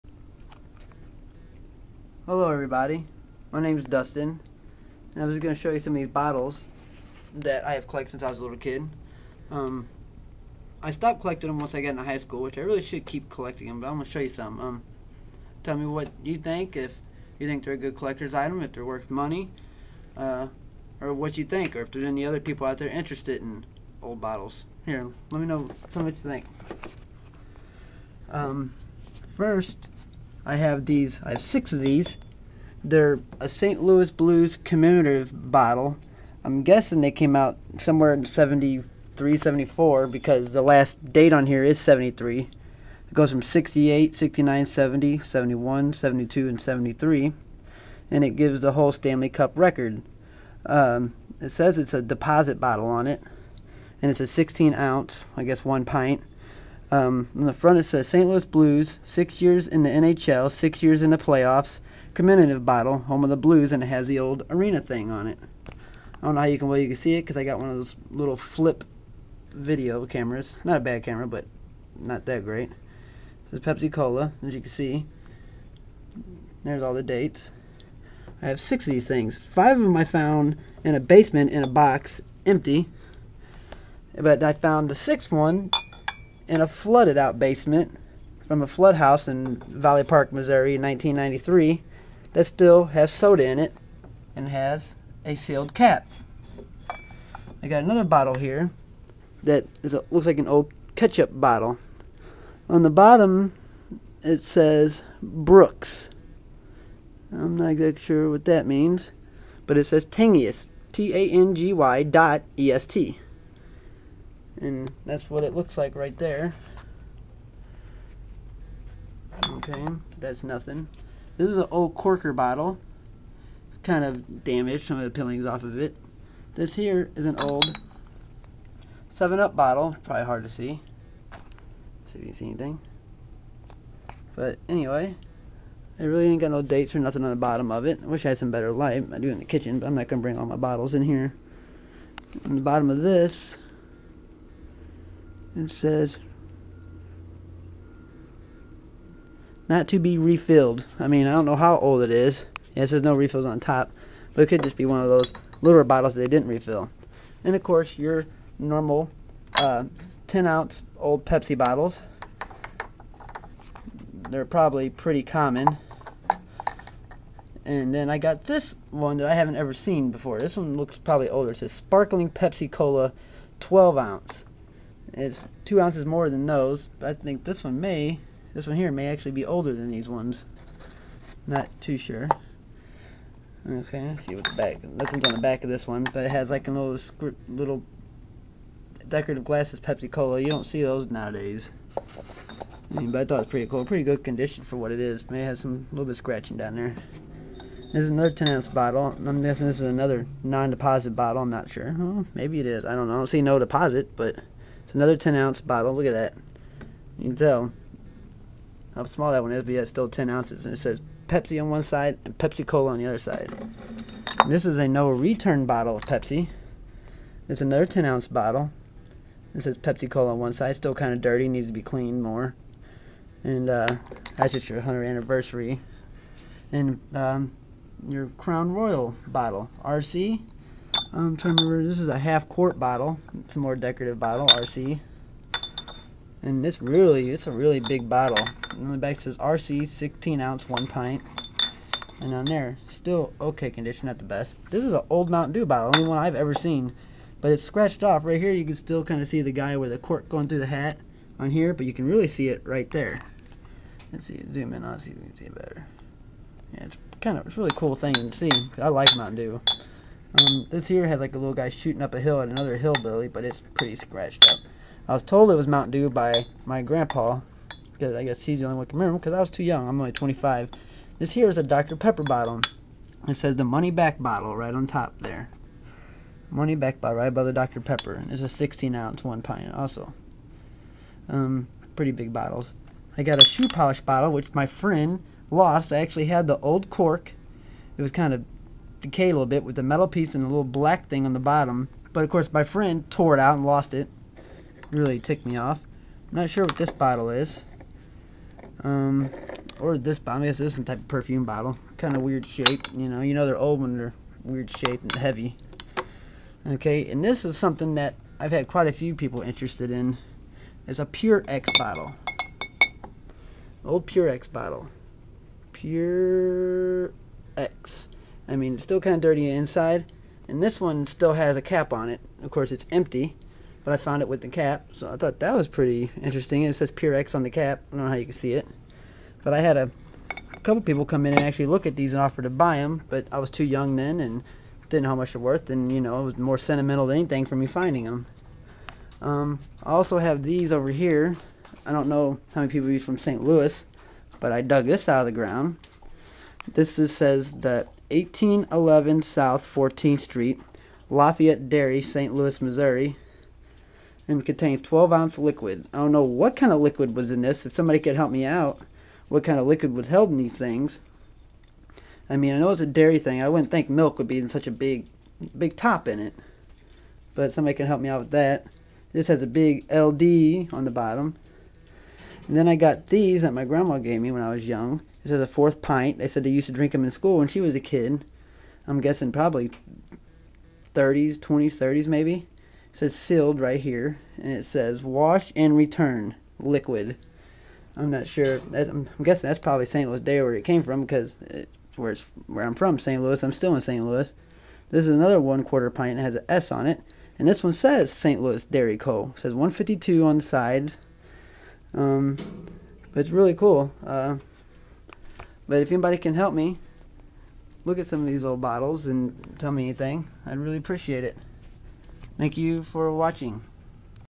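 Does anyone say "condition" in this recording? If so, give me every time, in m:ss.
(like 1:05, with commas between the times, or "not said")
3:14, 4:03.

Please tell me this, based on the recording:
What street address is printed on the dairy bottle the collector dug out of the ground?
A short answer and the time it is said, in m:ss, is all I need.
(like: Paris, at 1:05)
1811 South 14th Street, at 5:48.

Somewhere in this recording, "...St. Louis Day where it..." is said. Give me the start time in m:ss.
6:29.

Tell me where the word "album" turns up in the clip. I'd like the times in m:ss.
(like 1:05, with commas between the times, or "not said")
not said.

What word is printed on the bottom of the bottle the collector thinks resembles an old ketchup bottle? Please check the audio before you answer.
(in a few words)
Brooks.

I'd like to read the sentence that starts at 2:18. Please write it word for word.
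I wish I had some better light.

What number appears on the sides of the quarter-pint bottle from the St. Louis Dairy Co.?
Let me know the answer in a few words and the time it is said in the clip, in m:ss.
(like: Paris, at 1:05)
152, at 6:39.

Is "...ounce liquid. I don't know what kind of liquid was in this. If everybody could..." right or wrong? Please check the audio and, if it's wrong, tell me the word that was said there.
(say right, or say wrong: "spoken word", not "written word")
wrong: "somebody", not "everybody".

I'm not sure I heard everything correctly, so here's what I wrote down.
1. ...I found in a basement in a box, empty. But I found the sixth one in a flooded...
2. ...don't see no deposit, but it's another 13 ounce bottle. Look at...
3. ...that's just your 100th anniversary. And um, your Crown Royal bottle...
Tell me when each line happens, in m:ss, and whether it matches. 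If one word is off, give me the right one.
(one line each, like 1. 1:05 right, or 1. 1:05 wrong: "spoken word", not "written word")
1. 1:19 right
2. 3:23 wrong: "10", not "13"
3. 3:44 right.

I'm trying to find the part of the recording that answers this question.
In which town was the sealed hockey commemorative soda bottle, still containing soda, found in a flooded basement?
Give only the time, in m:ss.
1:29.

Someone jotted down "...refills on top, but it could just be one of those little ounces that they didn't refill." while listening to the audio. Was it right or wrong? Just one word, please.
wrong.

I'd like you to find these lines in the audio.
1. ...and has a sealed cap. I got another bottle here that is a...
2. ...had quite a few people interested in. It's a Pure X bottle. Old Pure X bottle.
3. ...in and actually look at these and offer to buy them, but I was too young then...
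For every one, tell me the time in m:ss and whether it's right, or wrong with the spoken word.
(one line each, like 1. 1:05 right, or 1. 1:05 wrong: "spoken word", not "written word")
1. 1:34 right
2. 5:08 right
3. 5:31 right.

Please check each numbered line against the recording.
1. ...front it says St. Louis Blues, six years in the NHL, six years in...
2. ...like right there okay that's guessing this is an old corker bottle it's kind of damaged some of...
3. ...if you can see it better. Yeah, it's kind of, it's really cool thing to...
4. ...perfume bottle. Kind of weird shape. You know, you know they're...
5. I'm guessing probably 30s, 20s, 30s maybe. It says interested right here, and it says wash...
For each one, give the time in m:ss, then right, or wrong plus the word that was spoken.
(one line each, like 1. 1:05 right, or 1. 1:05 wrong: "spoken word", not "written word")
1. 0:57 right
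2. 1:55 wrong: "nothing", not "guessing"
3. 4:15 right
4. 5:01 right
5. 6:18 wrong: "sealed", not "interested".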